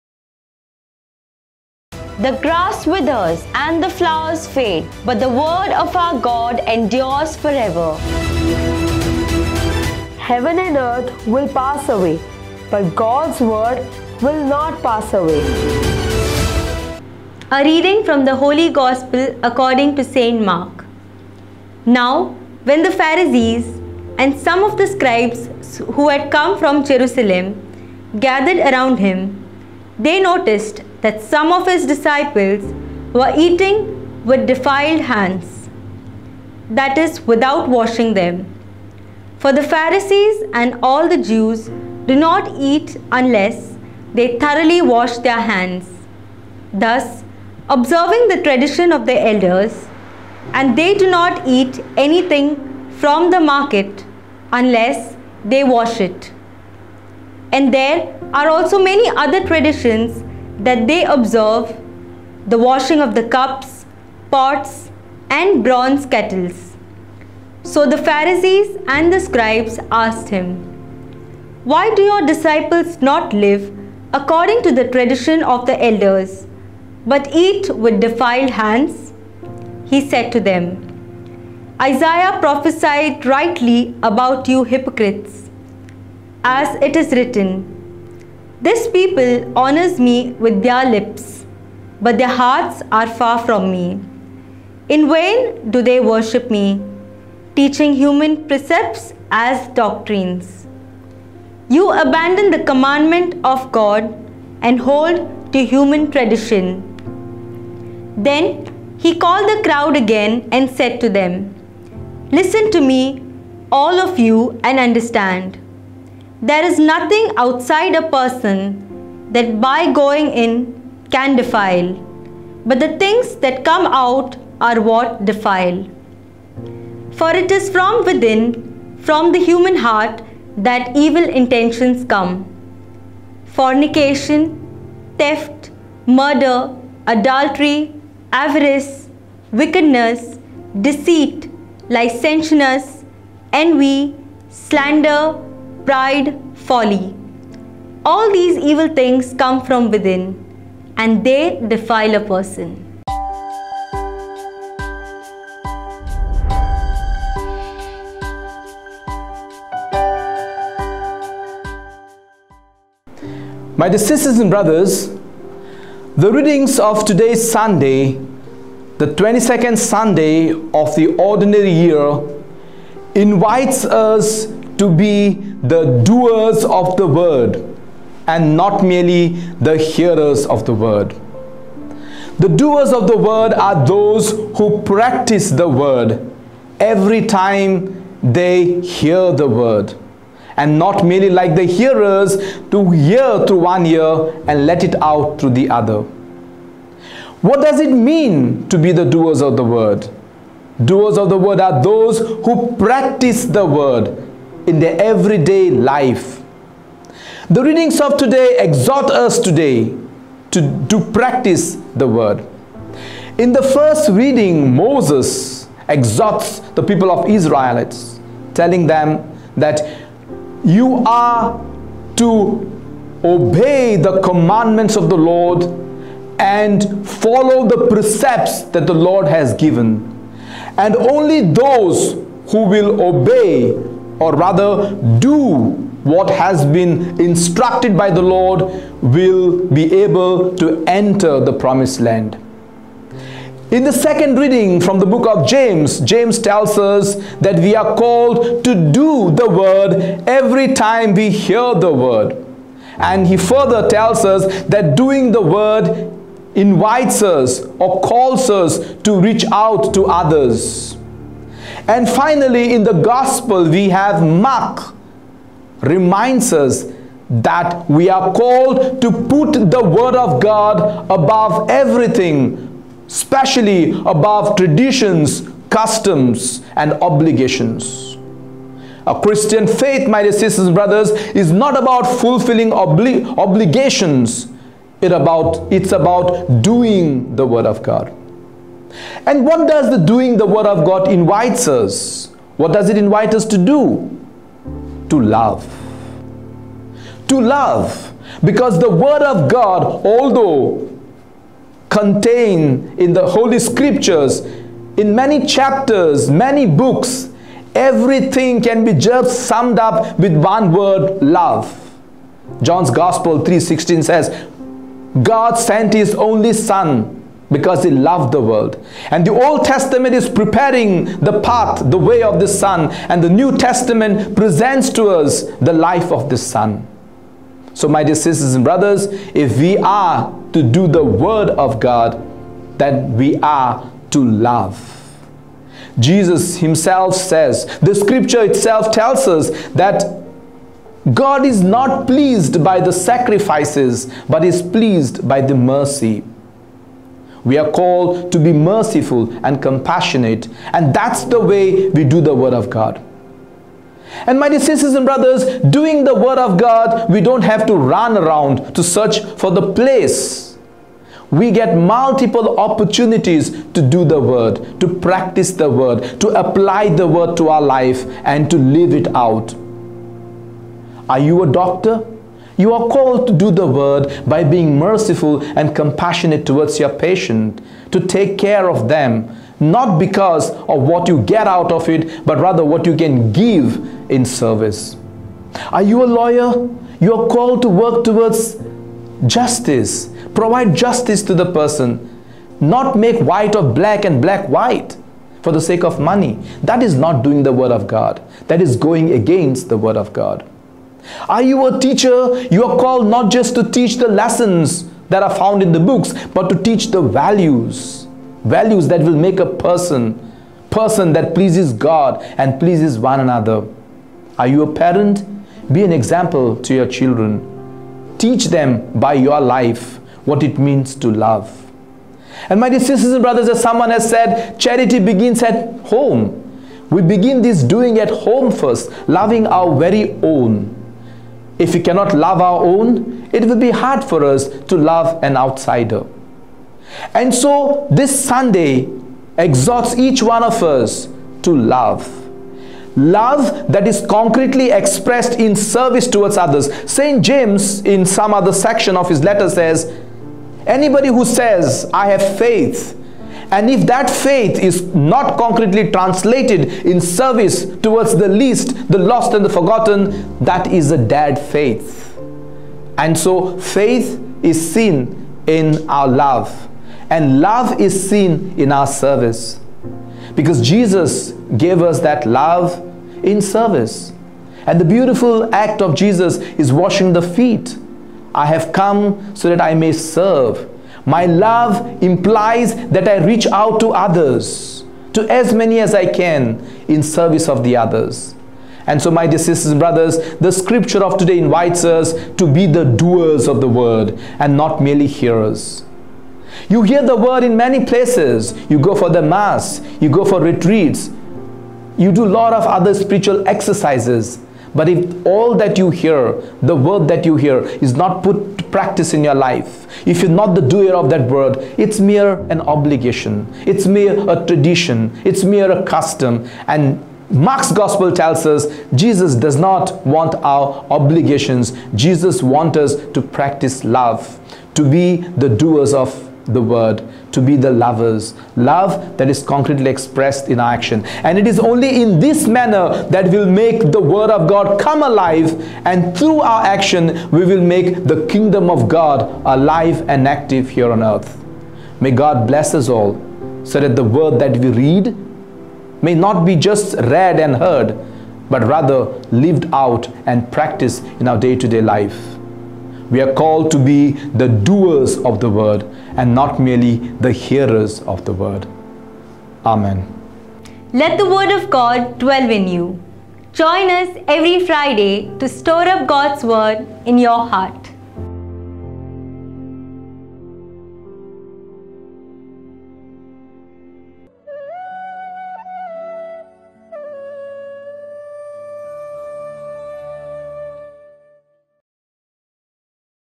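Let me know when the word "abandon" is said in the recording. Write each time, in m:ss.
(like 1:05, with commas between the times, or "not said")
1:42.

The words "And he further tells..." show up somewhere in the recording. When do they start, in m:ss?
4:12.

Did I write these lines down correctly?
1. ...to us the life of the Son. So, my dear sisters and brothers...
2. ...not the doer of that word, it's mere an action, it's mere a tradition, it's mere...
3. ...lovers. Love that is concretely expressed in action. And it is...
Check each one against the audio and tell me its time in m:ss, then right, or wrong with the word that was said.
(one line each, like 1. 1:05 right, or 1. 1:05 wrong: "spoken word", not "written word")
1. 5:24 right
2. 8:30 wrong: "obligation", not "action"
3. 8:47 right.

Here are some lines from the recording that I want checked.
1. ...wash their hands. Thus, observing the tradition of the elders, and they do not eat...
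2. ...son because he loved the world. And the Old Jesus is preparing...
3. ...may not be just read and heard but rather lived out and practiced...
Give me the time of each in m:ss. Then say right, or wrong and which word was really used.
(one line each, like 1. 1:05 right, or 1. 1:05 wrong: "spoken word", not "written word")
1. 0:44 right
2. 5:16 wrong: "Testament", not "Jesus"
3. 9:06 right.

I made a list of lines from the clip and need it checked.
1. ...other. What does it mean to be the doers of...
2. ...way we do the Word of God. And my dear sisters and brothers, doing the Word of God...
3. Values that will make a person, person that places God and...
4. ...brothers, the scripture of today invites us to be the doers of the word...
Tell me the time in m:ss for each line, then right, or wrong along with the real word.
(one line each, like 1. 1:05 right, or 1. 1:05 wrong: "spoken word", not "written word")
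1. 3:15 right
2. 5:51 right
3. 6:48 wrong: "pleases", not "places"
4. 8:09 right.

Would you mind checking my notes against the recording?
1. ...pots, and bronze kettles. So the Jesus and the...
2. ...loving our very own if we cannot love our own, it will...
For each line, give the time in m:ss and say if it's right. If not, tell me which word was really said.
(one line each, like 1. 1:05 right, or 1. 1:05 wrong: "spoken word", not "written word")
1. 1:04 wrong: "Pharisees", not "Jesus"
2. 7:09 right.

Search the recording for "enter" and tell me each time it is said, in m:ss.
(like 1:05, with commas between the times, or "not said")
4:00.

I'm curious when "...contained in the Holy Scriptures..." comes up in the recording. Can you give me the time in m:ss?
5:01.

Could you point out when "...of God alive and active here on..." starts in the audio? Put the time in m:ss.
8:58.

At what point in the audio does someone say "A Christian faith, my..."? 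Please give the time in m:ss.
4:39.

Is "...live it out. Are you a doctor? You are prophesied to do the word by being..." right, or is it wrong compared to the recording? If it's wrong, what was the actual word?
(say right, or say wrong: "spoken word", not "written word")
wrong: "called", not "prophesied".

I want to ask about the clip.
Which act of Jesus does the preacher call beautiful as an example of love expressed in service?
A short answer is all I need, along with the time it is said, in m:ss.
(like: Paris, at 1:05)
Washing the feet, at 7:56.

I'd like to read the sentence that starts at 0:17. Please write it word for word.
A reading from the Holy Gospel according to St.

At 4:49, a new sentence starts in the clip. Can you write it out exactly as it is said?
And what does the doing the word of God invites us?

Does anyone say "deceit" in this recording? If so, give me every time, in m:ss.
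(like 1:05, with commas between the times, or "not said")
2:20.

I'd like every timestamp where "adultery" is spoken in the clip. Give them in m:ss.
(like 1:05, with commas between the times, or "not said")
2:17.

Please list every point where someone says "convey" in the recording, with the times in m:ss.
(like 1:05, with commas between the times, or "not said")
not said.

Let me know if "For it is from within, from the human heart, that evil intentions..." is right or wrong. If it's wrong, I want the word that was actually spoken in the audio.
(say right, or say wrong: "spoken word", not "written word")
right.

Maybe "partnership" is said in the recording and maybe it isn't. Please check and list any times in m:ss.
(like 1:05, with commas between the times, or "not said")
not said.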